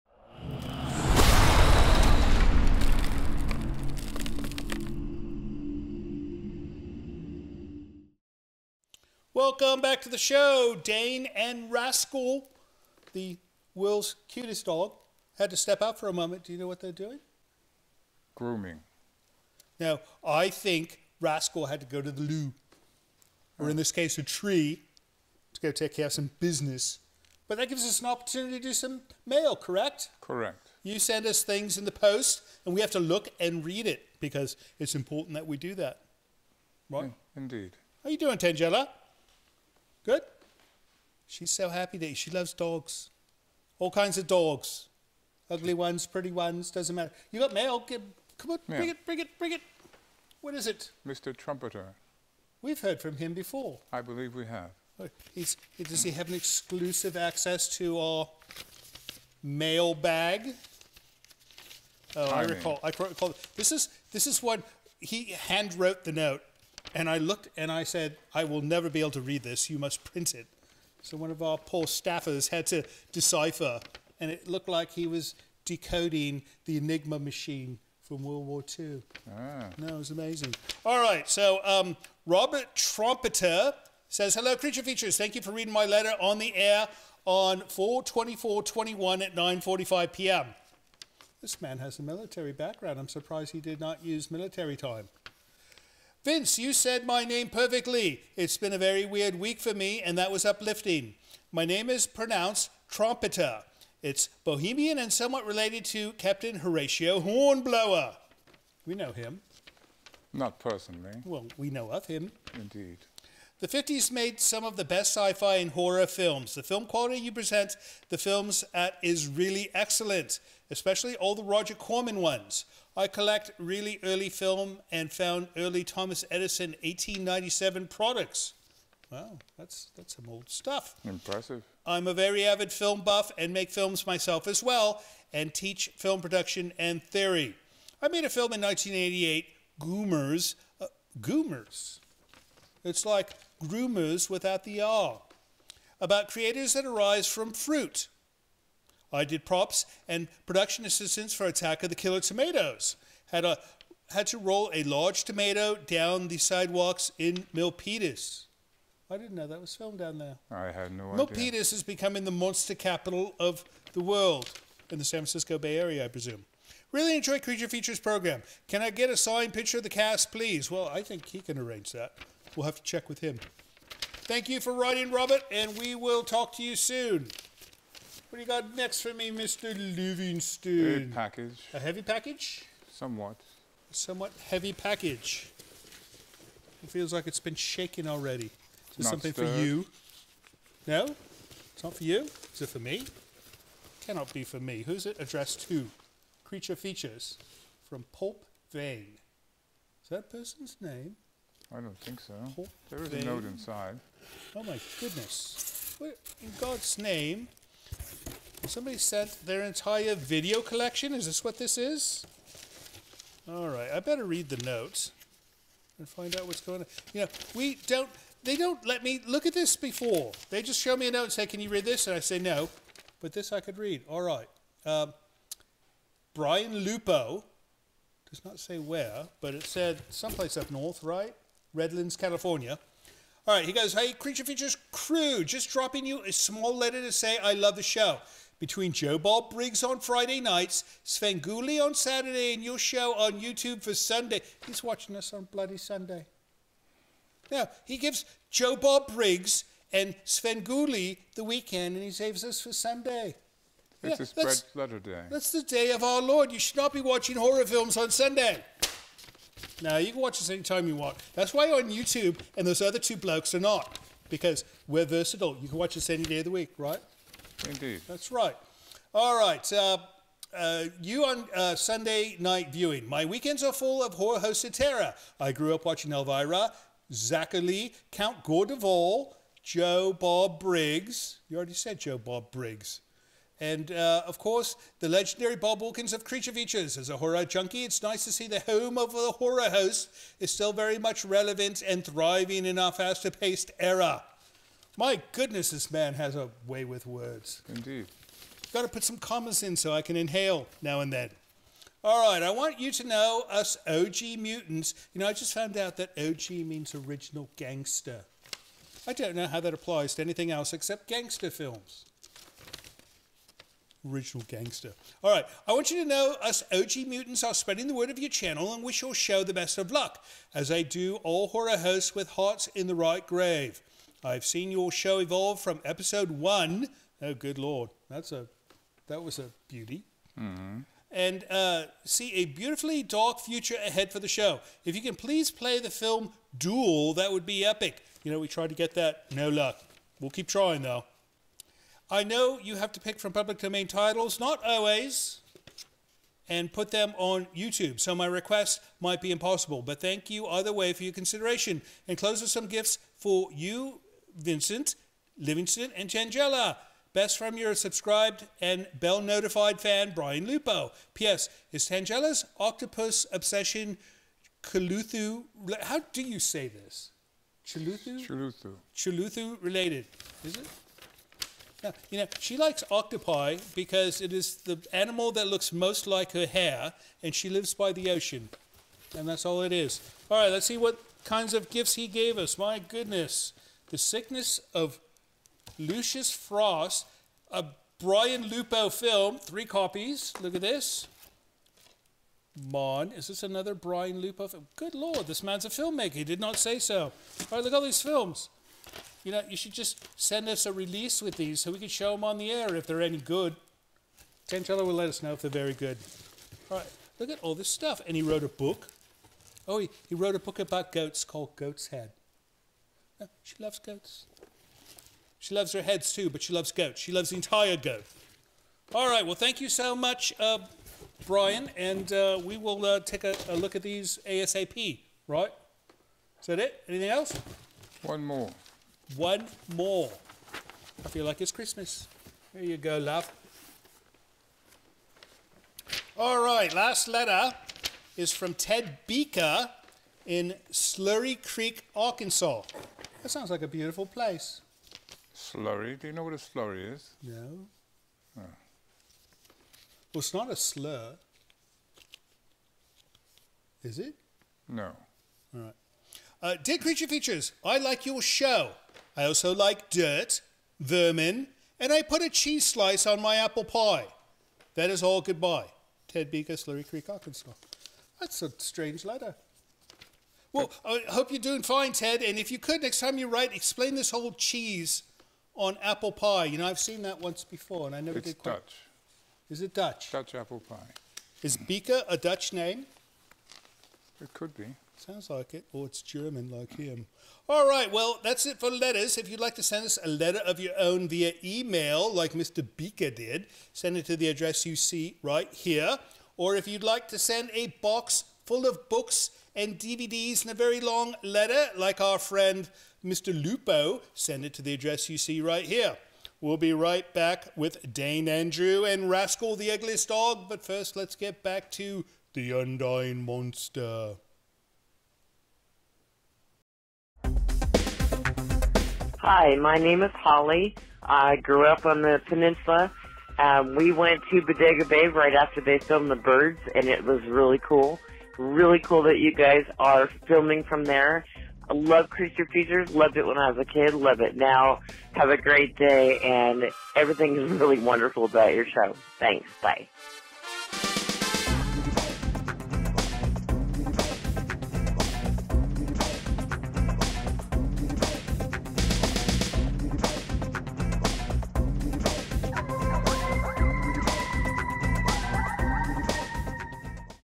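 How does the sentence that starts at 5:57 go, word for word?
Best from your subscribed and bell notified fan, Brian Lupo.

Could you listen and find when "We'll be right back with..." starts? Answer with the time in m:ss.
8:26.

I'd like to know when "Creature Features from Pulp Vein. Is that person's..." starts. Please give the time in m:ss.
3:16.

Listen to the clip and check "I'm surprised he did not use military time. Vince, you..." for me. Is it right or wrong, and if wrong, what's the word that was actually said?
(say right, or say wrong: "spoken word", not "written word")
right.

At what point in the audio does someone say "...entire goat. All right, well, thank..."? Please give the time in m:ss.
6:57.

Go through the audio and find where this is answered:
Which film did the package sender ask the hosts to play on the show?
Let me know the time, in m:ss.
5:36.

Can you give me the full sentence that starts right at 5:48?
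So my request might be impossible, but thank you either way for your consideration.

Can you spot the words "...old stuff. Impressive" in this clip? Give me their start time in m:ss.
2:10.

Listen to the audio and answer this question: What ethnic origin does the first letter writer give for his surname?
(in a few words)
Bohemian.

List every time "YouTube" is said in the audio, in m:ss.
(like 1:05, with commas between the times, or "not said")
4:03, 4:21, 5:47.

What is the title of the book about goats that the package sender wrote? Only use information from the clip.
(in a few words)
Goat's Head.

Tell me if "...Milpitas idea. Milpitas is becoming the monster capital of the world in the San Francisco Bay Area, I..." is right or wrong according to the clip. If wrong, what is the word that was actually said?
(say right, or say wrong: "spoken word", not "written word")
right.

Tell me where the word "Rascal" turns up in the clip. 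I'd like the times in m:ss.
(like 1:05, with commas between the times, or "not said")
0:11, 0:21, 8:29.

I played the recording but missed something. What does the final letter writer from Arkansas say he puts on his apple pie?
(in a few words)
a cheese slice.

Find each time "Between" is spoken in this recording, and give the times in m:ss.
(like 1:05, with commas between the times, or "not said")
3:58.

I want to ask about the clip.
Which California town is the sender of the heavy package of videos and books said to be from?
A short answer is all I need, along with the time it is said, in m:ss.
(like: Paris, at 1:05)
Redlands, at 3:51.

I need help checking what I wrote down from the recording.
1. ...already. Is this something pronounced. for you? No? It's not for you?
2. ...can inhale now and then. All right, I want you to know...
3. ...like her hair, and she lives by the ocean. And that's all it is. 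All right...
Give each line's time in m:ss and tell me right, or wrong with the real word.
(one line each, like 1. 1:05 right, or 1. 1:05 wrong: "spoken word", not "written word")
1. 3:08 wrong: "stirred", not "pronounced"
2. 5:00 right
3. 6:16 right.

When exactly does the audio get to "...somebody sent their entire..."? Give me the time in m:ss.
3:28.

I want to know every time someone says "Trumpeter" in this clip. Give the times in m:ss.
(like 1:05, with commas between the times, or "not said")
0:51, 1:22.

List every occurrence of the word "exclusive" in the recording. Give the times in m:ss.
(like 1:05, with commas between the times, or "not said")
0:56.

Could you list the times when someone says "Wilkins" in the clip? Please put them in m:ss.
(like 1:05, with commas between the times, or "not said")
4:45.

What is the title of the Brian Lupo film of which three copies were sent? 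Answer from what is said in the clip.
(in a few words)
The Sickness of Lucius Frost.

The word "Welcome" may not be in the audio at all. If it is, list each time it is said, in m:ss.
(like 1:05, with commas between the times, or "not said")
0:09.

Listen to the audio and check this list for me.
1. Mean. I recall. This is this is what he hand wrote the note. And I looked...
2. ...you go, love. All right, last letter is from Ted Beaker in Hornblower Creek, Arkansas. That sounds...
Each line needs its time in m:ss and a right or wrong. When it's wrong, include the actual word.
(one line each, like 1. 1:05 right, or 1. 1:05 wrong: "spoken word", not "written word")
1. 1:02 right
2. 7:12 wrong: "Slurry", not "Hornblower".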